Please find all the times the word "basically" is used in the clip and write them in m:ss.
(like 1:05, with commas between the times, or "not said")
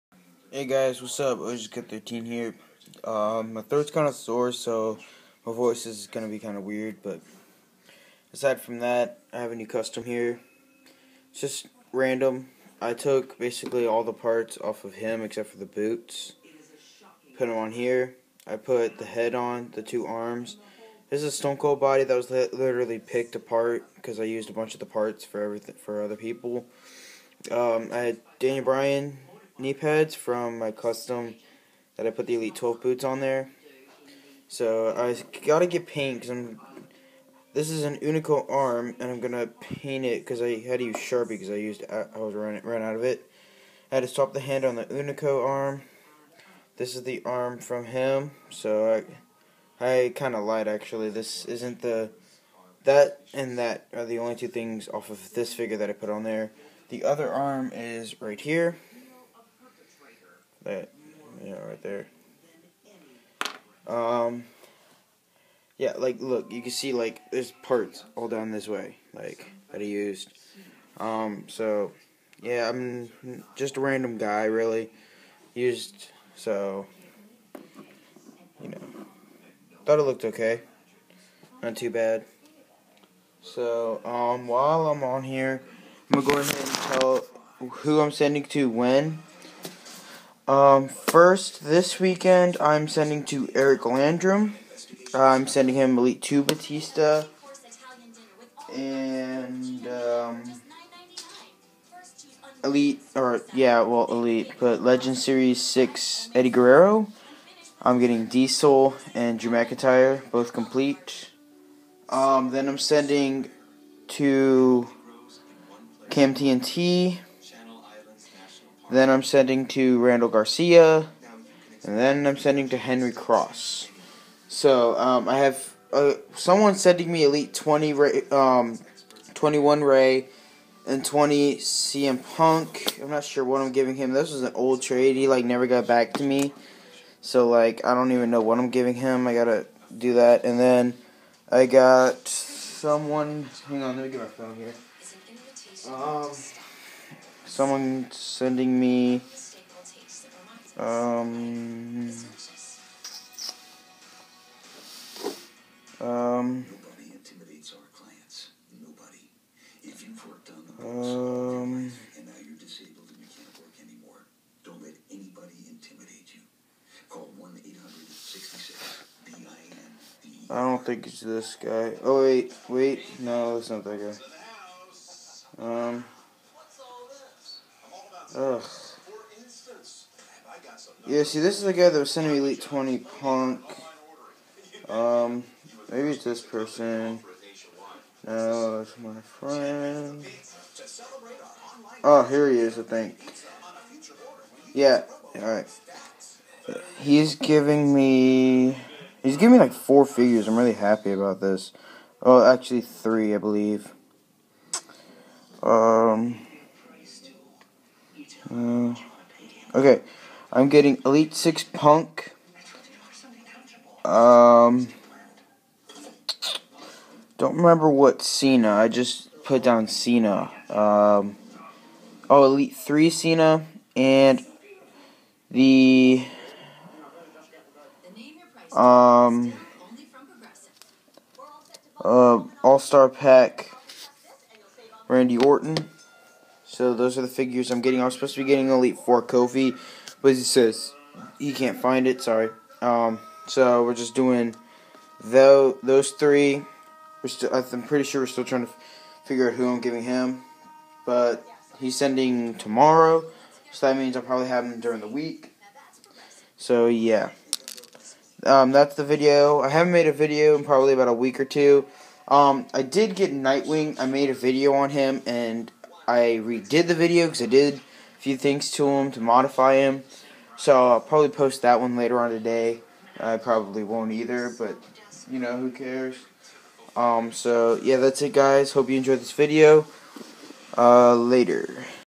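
0:13.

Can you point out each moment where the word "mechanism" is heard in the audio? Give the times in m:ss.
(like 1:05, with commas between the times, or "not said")
not said.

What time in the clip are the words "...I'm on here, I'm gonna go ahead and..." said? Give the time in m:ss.
1:24.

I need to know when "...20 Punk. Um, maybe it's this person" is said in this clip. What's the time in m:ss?
3:02.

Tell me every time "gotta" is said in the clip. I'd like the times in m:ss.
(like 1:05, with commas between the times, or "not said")
0:35, 2:19.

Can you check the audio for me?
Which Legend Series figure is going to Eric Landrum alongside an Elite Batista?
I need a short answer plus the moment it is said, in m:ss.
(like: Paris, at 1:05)
Eddie Guerrero, at 1:46.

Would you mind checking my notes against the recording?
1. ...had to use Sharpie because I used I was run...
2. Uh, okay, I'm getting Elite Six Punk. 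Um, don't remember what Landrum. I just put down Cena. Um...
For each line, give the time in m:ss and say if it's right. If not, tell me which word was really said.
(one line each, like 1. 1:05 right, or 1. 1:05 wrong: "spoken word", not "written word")
1. 0:40 right
2. 3:28 wrong: "Cena", not "Landrum".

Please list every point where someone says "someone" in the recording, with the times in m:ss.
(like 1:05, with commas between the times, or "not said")
2:06, 2:22.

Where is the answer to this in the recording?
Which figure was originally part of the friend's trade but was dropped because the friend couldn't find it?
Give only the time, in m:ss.
3:58.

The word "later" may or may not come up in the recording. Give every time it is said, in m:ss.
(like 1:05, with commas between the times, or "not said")
4:31, 4:41.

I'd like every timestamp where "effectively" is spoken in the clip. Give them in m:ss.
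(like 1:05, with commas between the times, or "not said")
not said.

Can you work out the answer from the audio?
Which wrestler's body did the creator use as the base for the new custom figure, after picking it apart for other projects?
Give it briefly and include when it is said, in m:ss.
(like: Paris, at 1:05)
Stone Cold, at 0:21.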